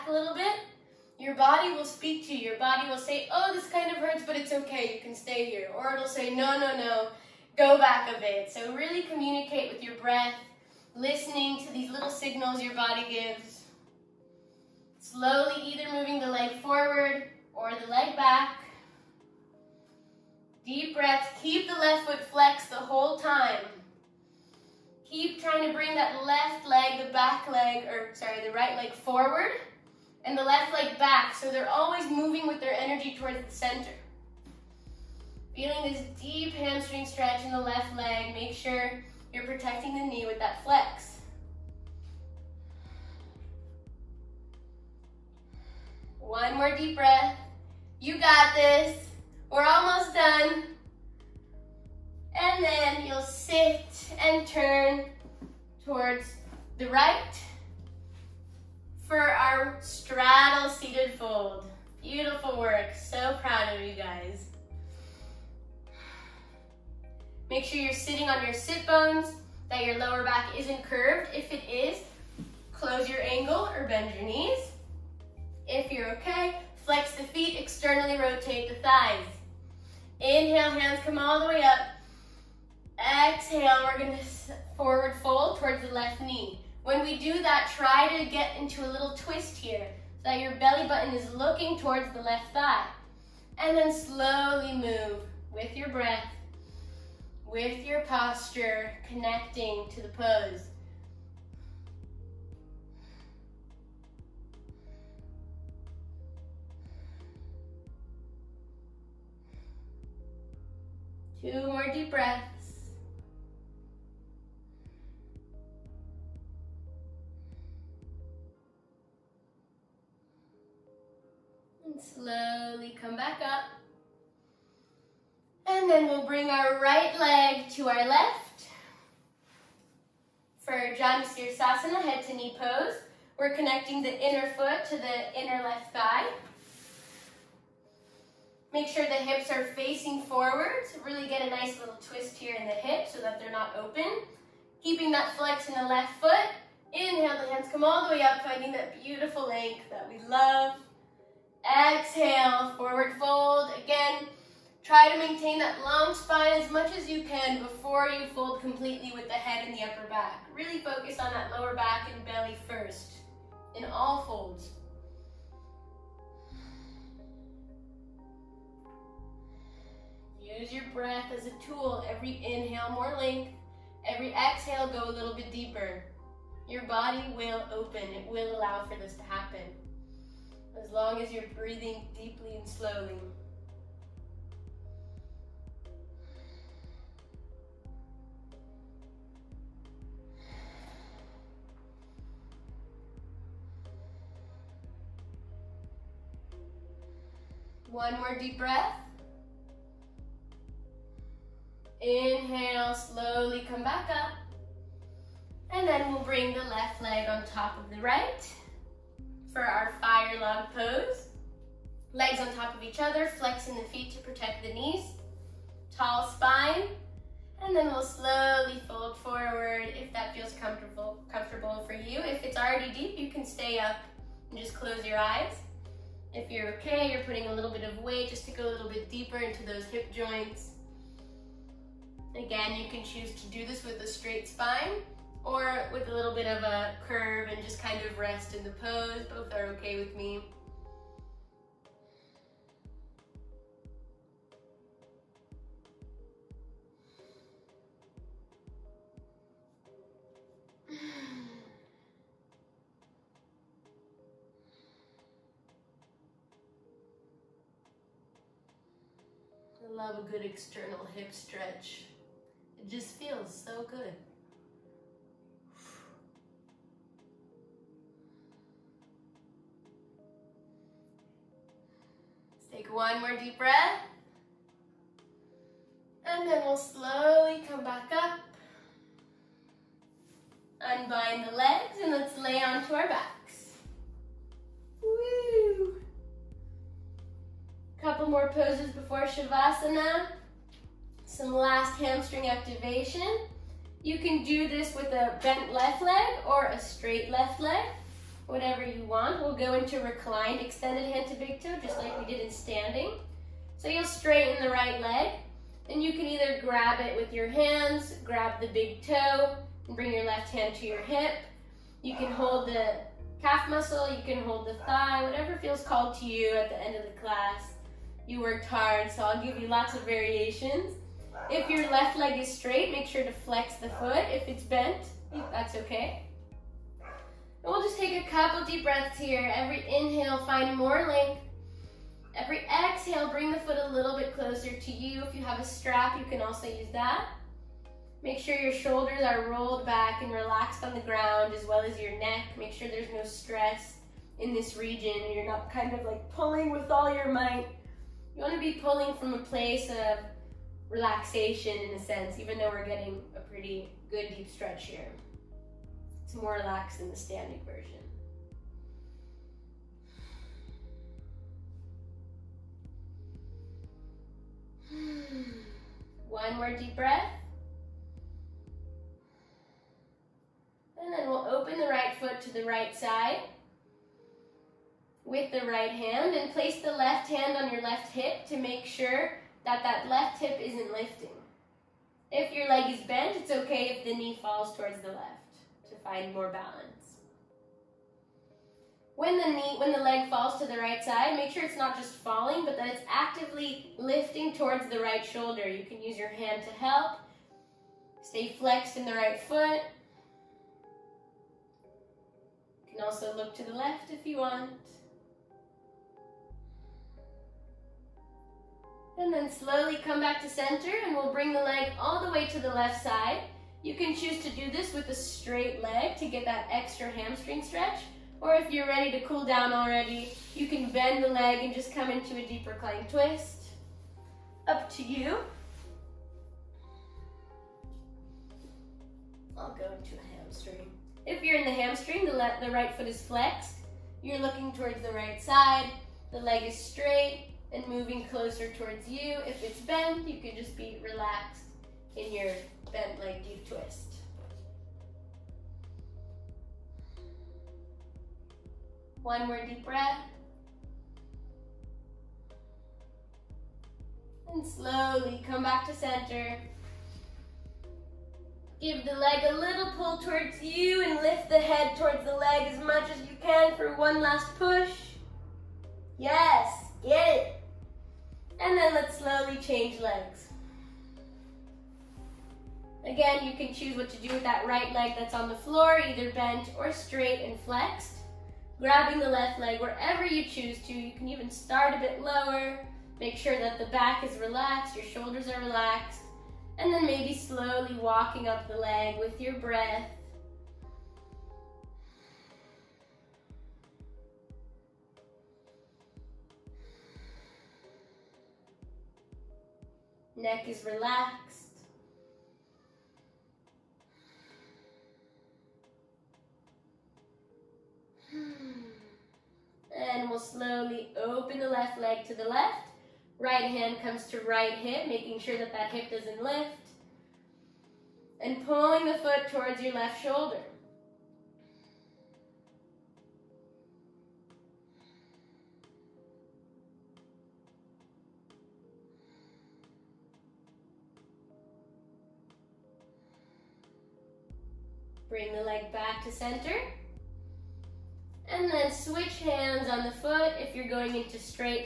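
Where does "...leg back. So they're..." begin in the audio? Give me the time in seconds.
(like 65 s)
30 s.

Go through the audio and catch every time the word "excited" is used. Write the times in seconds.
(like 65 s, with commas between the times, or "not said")
not said.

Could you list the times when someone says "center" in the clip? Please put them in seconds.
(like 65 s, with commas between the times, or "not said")
33 s, 410 s, 455 s, 536 s.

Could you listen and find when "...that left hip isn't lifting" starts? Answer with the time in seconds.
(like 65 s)
379 s.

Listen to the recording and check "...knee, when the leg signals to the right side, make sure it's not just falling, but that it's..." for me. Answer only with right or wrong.
wrong.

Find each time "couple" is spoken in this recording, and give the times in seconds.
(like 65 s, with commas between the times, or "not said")
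288 s, 328 s.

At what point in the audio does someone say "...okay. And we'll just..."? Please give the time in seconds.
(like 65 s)
325 s.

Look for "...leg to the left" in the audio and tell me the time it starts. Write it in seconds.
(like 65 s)
511 s.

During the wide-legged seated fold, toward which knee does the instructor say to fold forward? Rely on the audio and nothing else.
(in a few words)
Left knee.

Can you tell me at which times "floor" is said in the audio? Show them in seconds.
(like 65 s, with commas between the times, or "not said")
475 s.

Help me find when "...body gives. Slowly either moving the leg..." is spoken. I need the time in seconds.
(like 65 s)
12 s.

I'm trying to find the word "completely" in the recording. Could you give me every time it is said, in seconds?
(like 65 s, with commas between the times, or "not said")
158 s.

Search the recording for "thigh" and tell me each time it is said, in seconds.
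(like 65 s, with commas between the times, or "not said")
78 s, 92 s, 135 s, 314 s.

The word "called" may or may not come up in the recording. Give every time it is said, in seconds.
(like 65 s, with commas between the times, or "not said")
315 s.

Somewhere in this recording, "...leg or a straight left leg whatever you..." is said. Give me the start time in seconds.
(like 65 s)
296 s.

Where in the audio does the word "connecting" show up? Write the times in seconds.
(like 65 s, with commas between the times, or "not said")
99 s, 133 s.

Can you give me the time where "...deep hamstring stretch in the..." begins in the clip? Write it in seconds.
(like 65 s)
36 s.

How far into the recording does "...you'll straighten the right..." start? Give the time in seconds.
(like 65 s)
303 s.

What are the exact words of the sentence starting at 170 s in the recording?
Use your breath as a tool.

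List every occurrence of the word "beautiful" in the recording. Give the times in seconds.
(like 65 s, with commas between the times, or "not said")
62 s, 149 s.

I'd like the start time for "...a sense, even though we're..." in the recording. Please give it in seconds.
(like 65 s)
351 s.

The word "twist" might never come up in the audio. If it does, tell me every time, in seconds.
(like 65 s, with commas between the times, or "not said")
89 s, 141 s, 423 s, 443 s.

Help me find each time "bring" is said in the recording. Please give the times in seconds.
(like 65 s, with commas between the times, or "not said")
25 s, 126 s, 206 s, 309 s, 333 s, 411 s, 535 s.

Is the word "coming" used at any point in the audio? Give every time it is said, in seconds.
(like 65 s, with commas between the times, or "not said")
not said.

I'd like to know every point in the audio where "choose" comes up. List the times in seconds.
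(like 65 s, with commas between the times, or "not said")
233 s, 414 s, 473 s, 480 s.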